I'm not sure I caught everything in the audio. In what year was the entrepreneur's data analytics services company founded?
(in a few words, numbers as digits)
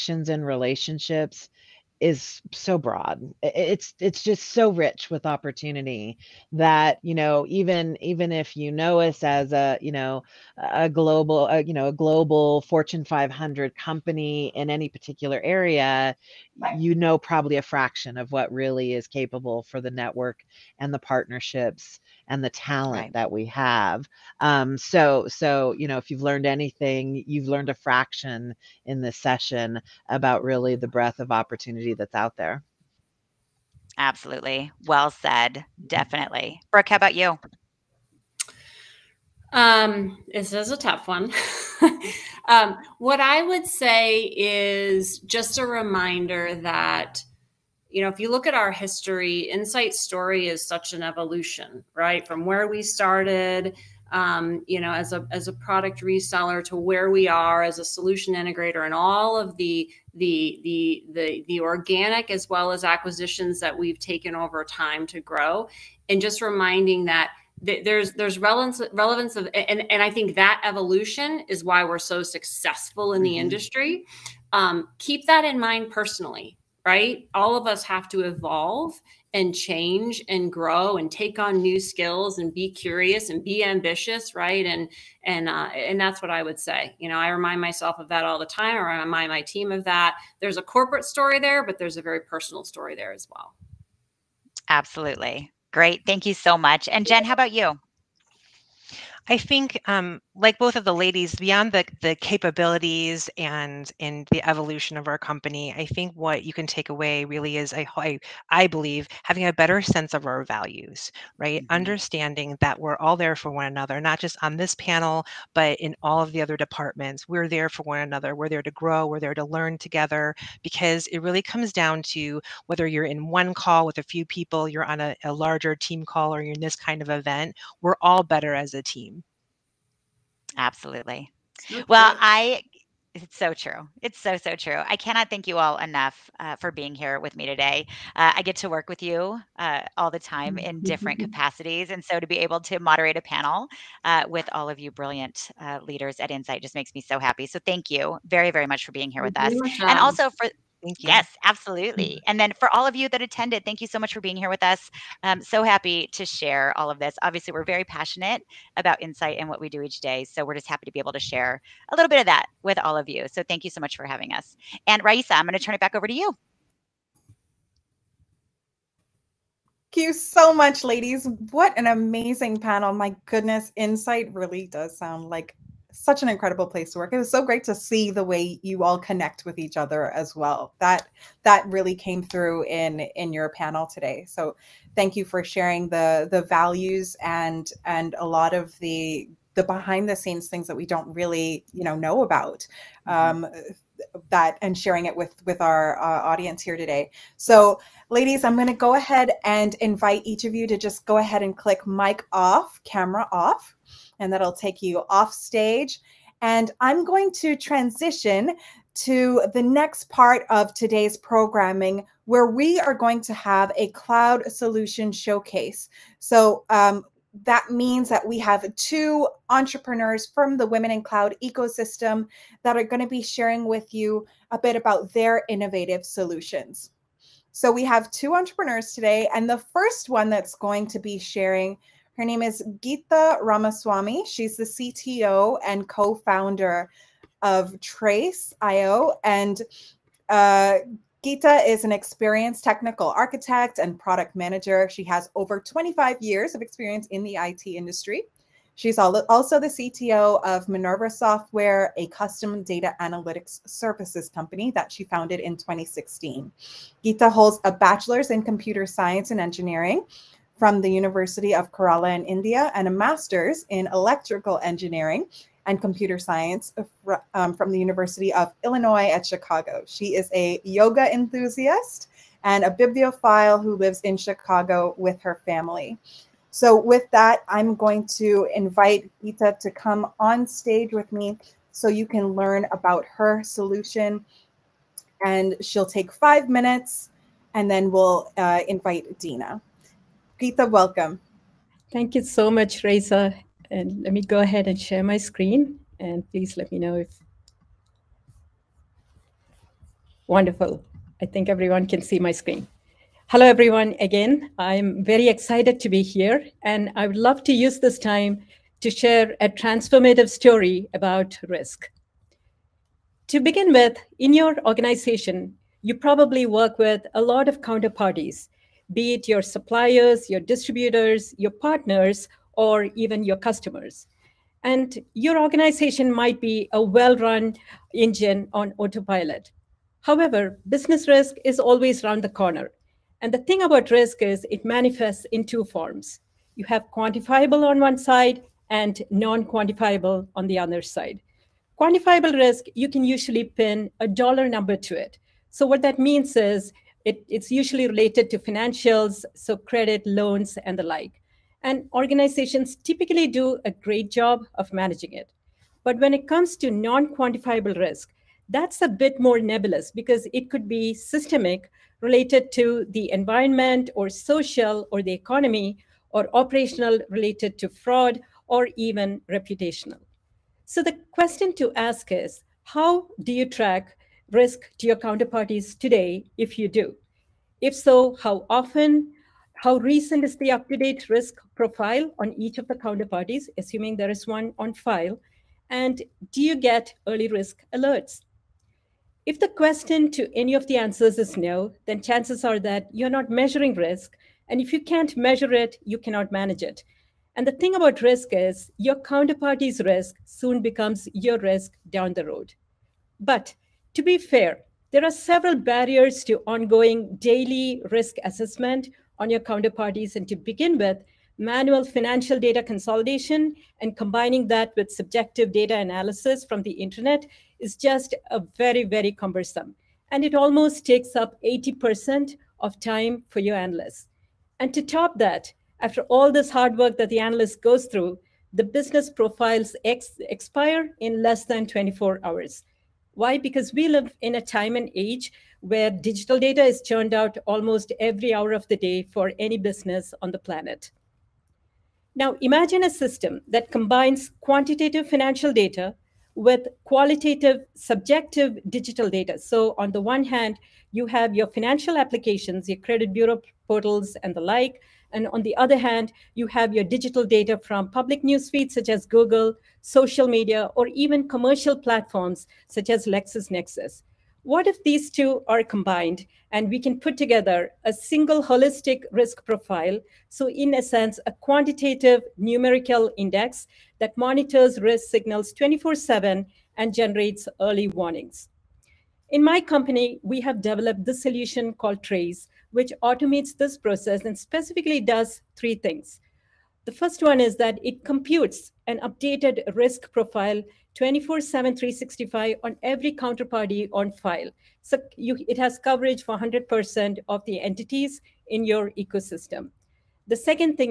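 2016.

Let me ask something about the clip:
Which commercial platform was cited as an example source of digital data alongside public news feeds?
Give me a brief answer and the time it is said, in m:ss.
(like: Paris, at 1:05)
LexisNexis, at 7:43.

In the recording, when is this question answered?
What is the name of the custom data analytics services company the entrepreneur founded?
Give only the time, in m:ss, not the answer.
4:10.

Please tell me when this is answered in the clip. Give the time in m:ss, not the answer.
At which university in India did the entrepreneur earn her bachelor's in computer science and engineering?
4:20.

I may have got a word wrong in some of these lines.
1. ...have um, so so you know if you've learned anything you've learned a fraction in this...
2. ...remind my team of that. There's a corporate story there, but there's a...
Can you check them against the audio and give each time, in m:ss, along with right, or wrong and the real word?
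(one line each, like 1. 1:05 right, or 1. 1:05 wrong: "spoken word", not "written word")
1. 0:23 right
2. 1:29 right.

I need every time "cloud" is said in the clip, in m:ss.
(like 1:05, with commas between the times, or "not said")
3:33, 3:41.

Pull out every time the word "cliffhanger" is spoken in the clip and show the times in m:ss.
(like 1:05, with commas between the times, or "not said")
not said.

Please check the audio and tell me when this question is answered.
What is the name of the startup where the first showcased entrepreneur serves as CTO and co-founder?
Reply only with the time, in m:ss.
3:57.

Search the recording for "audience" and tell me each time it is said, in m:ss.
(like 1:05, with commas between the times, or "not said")
3:16.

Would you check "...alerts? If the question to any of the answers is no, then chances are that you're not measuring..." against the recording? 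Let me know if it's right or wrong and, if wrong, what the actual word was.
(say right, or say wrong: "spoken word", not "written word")
right.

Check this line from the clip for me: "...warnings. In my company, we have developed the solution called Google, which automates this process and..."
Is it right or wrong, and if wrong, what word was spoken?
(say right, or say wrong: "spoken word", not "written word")
wrong: "Trace", not "Google".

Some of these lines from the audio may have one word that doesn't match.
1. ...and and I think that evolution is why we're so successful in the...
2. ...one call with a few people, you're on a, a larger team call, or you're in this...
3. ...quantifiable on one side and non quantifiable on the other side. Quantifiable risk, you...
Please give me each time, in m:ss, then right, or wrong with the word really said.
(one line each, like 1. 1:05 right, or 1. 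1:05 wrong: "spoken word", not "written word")
1. 1:09 right
2. 2:03 right
3. 5:36 right.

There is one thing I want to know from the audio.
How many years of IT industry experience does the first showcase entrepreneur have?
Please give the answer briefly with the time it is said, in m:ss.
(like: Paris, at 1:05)
25, at 4:05.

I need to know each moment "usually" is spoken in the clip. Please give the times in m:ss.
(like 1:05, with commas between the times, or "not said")
5:43, 5:47.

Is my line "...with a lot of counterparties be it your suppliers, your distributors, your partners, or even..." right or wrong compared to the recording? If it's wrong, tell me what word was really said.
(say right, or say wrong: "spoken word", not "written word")
right.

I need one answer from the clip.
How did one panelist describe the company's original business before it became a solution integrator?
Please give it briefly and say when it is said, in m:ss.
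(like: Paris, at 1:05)
Product reseller, at 0:55.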